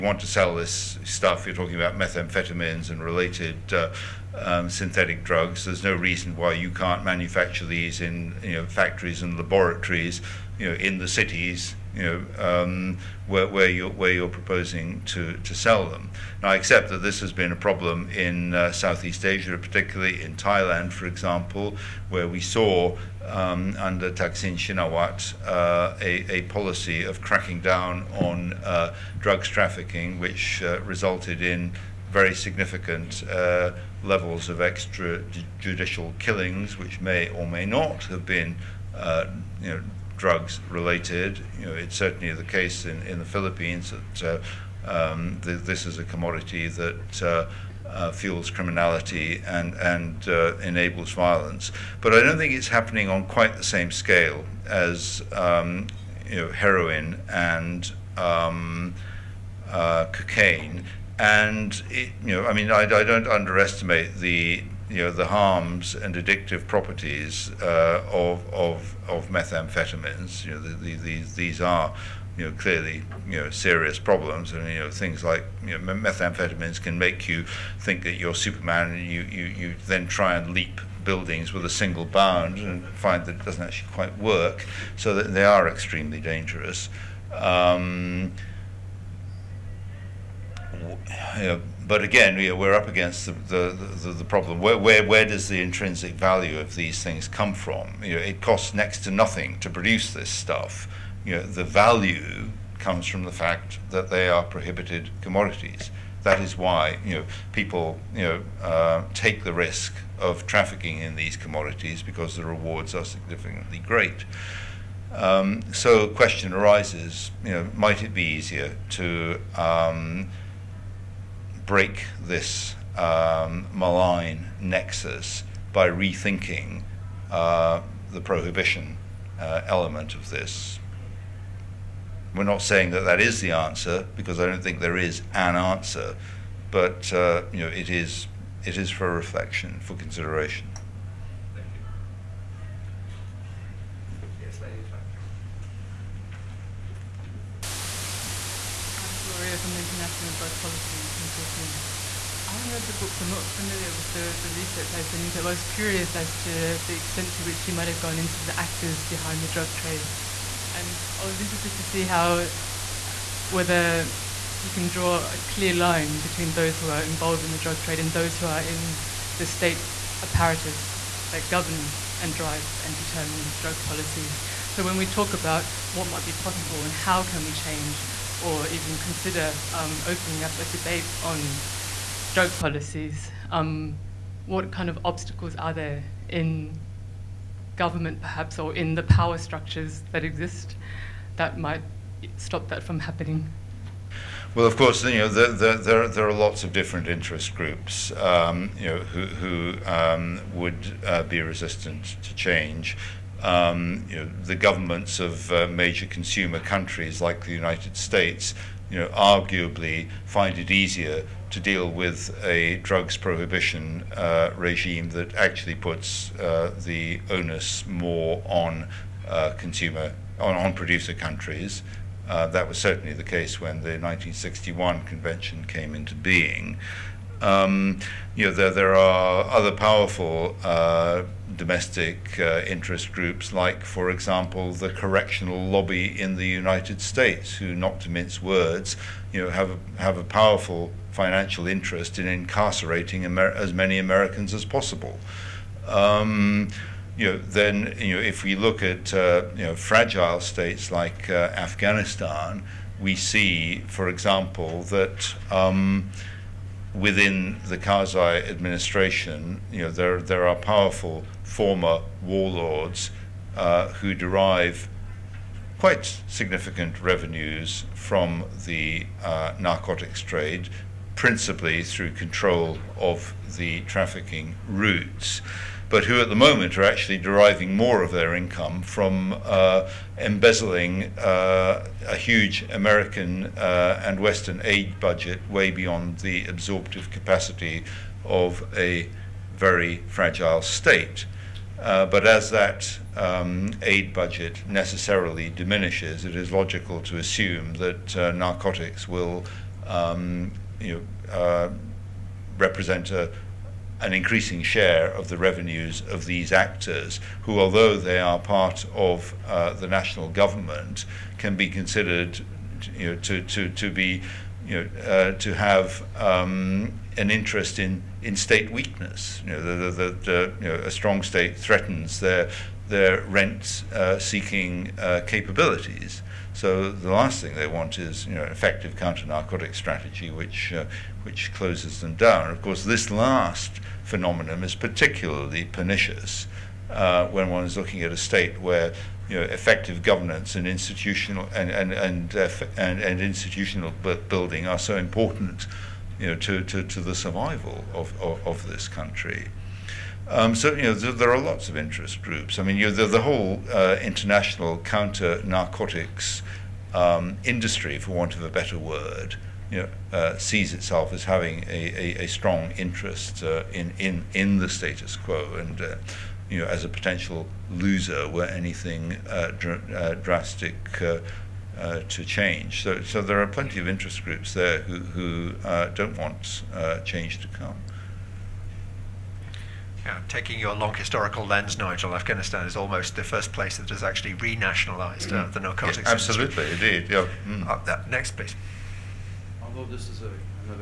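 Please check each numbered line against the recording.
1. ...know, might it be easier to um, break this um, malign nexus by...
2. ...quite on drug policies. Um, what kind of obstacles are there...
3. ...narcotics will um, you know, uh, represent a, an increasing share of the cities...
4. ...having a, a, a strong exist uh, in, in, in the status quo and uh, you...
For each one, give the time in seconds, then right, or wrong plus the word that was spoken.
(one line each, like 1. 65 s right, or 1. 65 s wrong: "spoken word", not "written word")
1. 117 s right
2. 180 s wrong: "debate", not "quite"
3. 298 s wrong: "revenues", not "cities"
4. 361 s wrong: "interest", not "exist".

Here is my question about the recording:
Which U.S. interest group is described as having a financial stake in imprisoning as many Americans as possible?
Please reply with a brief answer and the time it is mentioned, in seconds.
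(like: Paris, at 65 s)
correctional lobby, at 234 s.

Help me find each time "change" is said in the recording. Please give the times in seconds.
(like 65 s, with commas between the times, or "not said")
177 s, 202 s, 372 s, 376 s.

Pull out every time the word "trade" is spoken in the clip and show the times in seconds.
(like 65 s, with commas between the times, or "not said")
159 s, 167 s, 270 s.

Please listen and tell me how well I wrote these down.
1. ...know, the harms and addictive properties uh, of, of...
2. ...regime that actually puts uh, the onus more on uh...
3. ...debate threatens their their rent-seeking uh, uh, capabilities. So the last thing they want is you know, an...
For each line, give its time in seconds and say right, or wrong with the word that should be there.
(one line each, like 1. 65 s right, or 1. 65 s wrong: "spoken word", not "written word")
1. 64 s right
2. 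214 s right
3. 321 s wrong: "state", not "debate".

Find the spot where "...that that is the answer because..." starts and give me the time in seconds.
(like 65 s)
132 s.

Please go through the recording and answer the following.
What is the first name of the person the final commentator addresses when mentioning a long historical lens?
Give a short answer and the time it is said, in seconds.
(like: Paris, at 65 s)
Nigel, at 381 s.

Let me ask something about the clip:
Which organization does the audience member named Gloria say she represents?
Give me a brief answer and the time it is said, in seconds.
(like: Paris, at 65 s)
International Drug Policy Consortium, at 149 s.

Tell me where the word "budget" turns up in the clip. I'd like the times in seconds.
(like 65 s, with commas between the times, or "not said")
284 s, 294 s.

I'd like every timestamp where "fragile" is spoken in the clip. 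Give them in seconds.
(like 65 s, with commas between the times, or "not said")
249 s, 290 s.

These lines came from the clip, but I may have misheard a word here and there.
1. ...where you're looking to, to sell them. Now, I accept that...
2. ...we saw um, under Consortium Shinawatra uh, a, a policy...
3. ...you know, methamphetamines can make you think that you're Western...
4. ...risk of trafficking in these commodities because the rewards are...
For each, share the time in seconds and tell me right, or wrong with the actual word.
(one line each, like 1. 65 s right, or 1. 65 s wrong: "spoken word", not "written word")
1. 13 s wrong: "proposing", not "looking"
2. 22 s wrong: "Thaksin", not "Consortium"
3. 75 s wrong: "Superman", not "Western"
4. 109 s right.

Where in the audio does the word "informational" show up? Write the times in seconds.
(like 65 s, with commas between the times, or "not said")
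not said.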